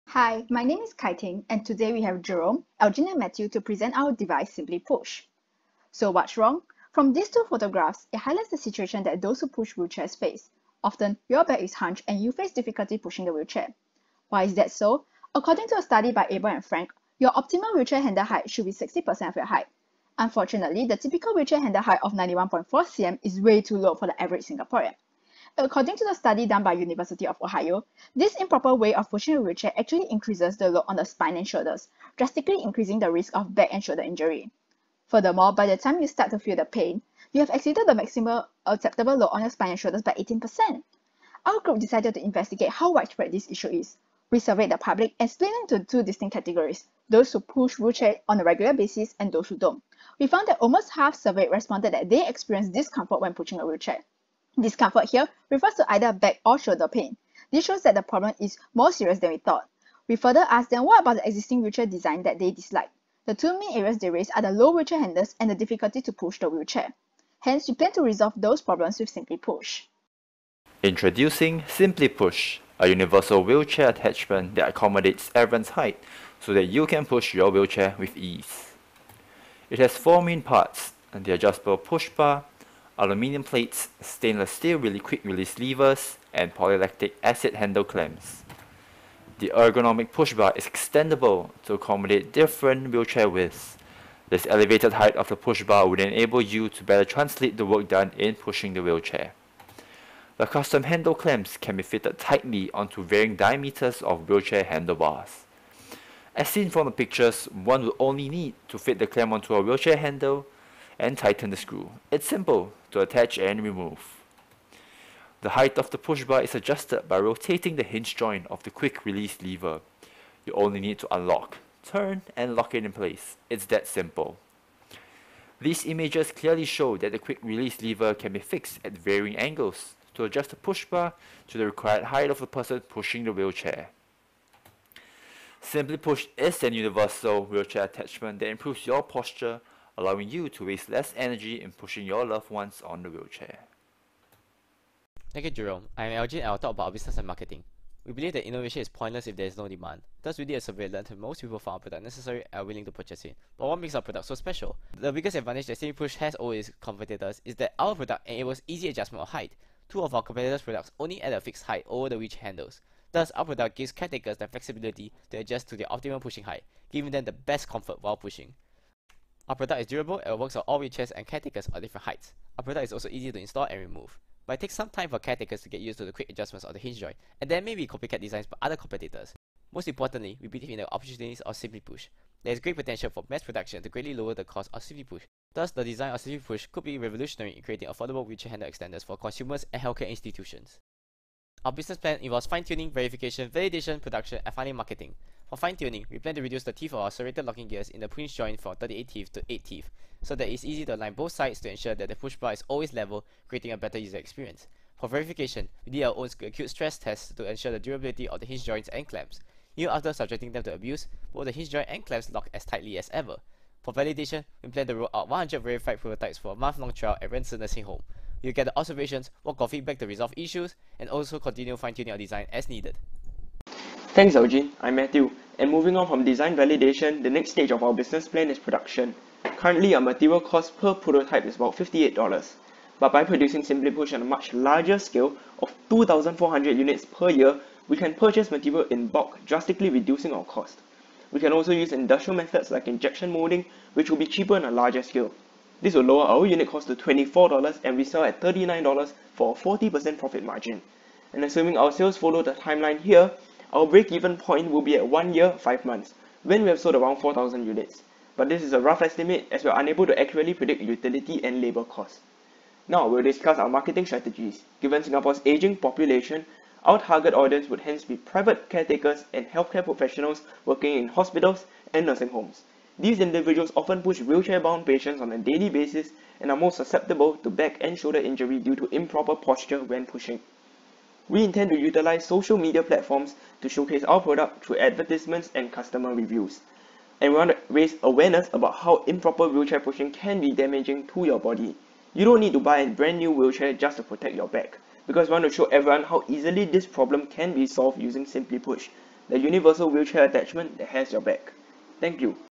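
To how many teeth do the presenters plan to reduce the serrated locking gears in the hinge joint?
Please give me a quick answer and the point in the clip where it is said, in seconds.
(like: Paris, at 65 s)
8, at 199 s.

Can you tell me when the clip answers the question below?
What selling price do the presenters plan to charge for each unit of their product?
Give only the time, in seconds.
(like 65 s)
248 s.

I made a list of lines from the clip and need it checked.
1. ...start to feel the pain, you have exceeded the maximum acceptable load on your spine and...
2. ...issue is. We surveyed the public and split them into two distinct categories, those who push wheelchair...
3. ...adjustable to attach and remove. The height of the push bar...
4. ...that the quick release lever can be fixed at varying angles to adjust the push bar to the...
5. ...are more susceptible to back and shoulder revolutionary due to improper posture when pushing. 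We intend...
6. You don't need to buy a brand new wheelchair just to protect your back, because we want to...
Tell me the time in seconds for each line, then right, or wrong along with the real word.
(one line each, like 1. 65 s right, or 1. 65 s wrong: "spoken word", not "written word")
1. 36 s right
2. 43 s right
3. 112 s wrong: "simple", not "adjustable"
4. 126 s right
5. 276 s wrong: "injury", not "revolutionary"
6. 292 s right.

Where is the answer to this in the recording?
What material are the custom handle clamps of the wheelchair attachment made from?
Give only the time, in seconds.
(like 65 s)
86 s.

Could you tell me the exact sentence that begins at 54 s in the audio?
Discomfort here refers to either back or shoulder pain.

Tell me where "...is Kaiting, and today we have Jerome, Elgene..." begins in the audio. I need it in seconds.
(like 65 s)
0 s.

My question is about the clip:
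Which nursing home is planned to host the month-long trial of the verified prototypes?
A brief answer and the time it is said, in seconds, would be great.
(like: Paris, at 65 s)
Ren Ci Nursing Home, at 217 s.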